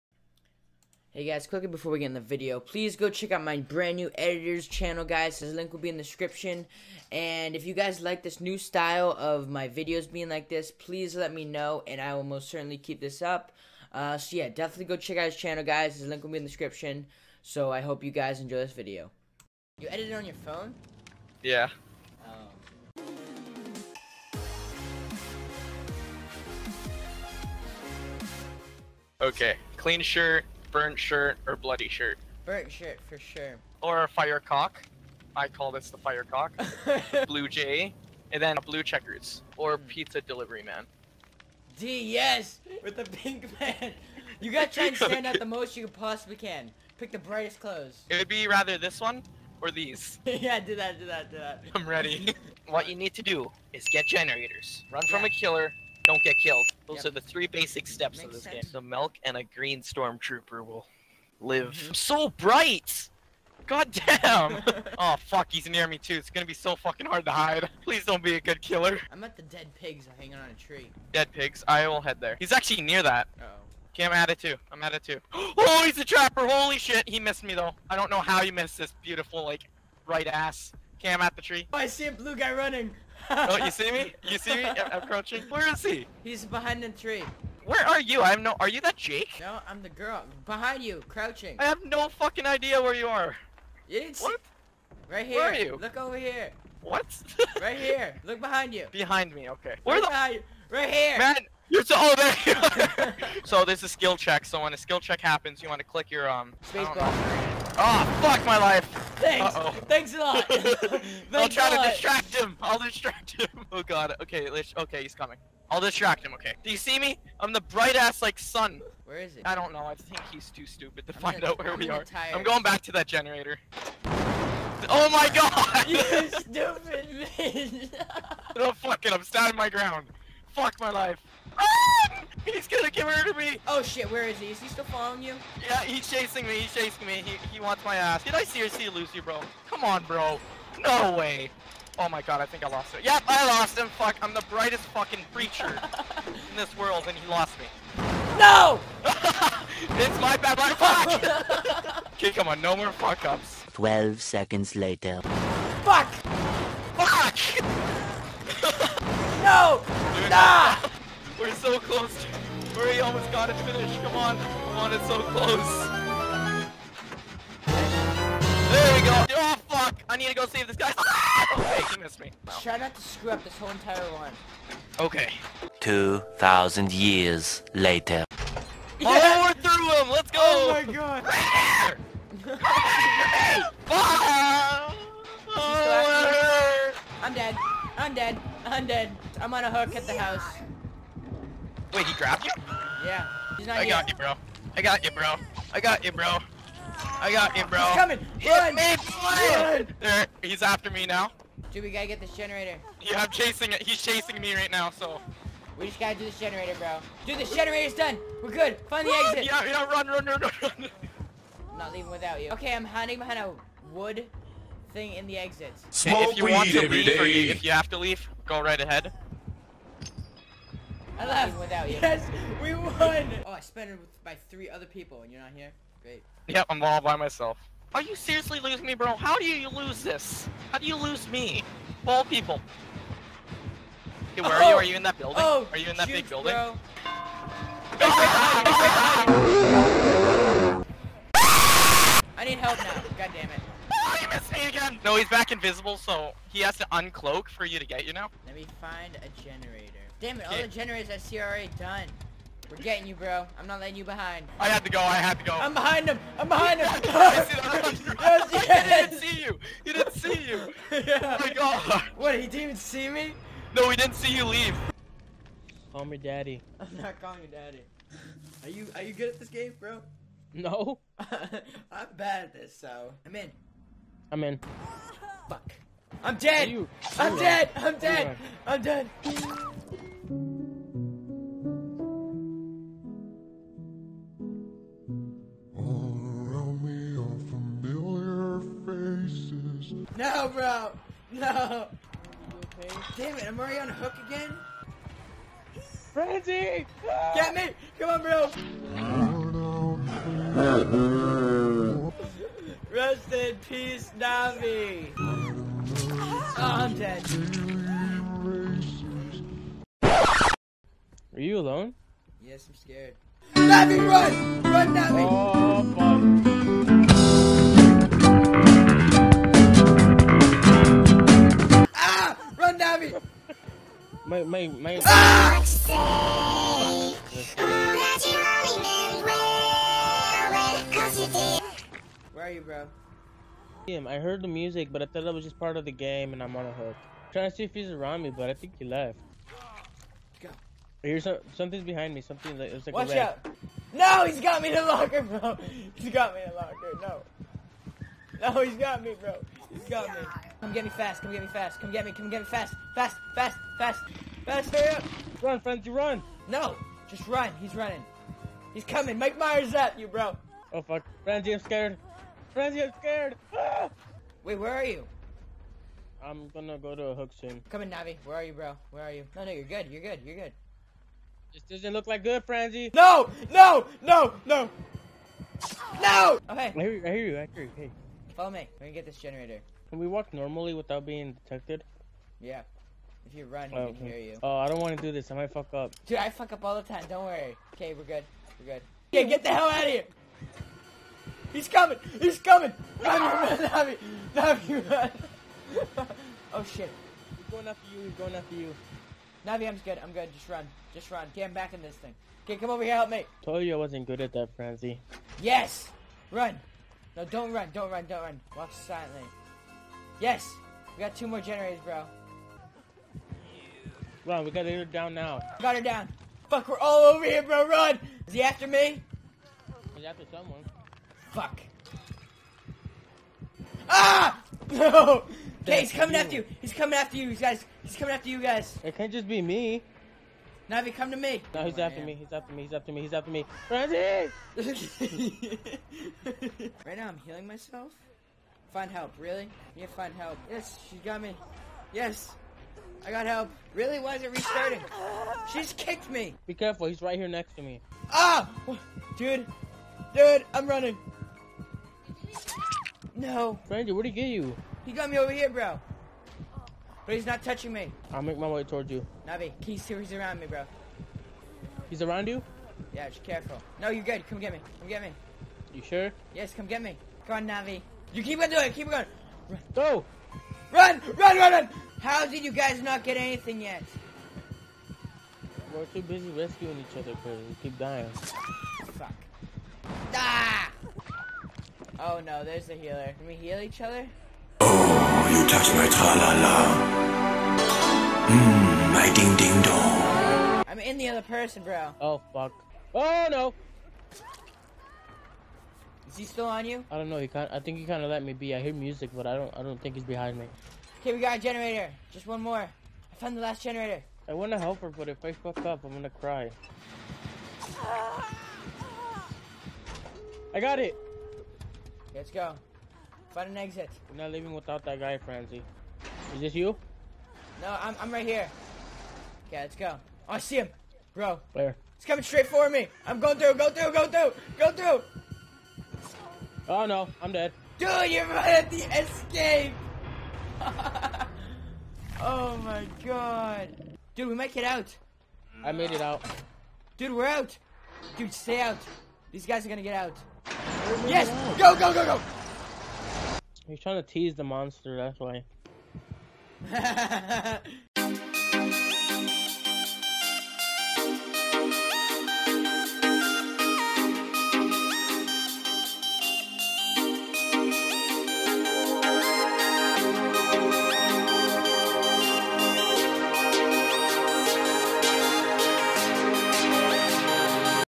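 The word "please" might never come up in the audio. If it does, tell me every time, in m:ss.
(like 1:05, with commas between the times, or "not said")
0:02, 0:10, 1:07.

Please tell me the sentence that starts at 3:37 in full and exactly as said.
Or if you have to leave, go right ahead.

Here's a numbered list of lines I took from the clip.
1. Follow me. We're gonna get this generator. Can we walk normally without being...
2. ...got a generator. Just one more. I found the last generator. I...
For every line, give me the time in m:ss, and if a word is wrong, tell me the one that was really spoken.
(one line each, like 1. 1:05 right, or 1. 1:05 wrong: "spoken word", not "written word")
1. 6:18 right
2. 8:21 right.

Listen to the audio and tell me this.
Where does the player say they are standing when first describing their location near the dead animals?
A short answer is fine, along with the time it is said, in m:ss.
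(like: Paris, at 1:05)
dead pigs hanging on a tree, at 1:09.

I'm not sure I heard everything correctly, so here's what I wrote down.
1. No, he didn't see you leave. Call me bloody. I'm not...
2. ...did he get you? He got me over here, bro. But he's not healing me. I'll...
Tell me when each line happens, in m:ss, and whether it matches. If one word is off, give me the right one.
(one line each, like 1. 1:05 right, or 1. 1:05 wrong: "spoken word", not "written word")
1. 4:23 wrong: "daddy", not "bloody"
2. 7:34 wrong: "touching", not "healing".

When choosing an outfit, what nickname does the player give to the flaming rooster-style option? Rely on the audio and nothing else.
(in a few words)
fire cock.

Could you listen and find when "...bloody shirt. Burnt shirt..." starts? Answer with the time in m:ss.
0:31.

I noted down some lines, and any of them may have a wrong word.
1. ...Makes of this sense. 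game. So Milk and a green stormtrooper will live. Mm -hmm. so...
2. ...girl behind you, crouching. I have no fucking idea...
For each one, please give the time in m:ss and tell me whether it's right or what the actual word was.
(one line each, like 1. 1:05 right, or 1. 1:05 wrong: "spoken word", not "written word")
1. 0:58 right
2. 1:29 right.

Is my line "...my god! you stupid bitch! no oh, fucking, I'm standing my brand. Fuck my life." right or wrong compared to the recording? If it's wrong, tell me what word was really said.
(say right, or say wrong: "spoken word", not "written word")
wrong: "ground", not "brand".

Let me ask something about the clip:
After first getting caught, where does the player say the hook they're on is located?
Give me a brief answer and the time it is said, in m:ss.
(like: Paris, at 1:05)
at the house, at 3:09.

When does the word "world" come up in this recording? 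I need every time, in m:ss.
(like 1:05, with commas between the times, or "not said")
2:26.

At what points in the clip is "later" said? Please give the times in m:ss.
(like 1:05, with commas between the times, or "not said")
2:34, 2:57.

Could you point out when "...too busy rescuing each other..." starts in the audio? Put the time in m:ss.
7:55.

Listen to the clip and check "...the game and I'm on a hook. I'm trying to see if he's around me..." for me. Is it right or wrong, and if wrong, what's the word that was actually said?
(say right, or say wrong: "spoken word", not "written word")
right.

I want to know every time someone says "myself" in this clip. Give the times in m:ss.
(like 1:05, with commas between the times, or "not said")
3:47, 7:17.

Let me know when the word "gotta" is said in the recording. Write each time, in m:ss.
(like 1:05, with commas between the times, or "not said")
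0:44, 3:21, 3:25, 6:54.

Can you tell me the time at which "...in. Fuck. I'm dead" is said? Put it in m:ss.
4:34.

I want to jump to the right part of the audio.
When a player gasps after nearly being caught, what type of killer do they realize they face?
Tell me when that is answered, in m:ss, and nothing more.
1:16.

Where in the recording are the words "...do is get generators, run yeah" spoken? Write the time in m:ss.
0:53.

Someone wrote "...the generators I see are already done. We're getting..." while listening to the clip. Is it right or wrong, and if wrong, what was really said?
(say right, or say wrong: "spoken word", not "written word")
right.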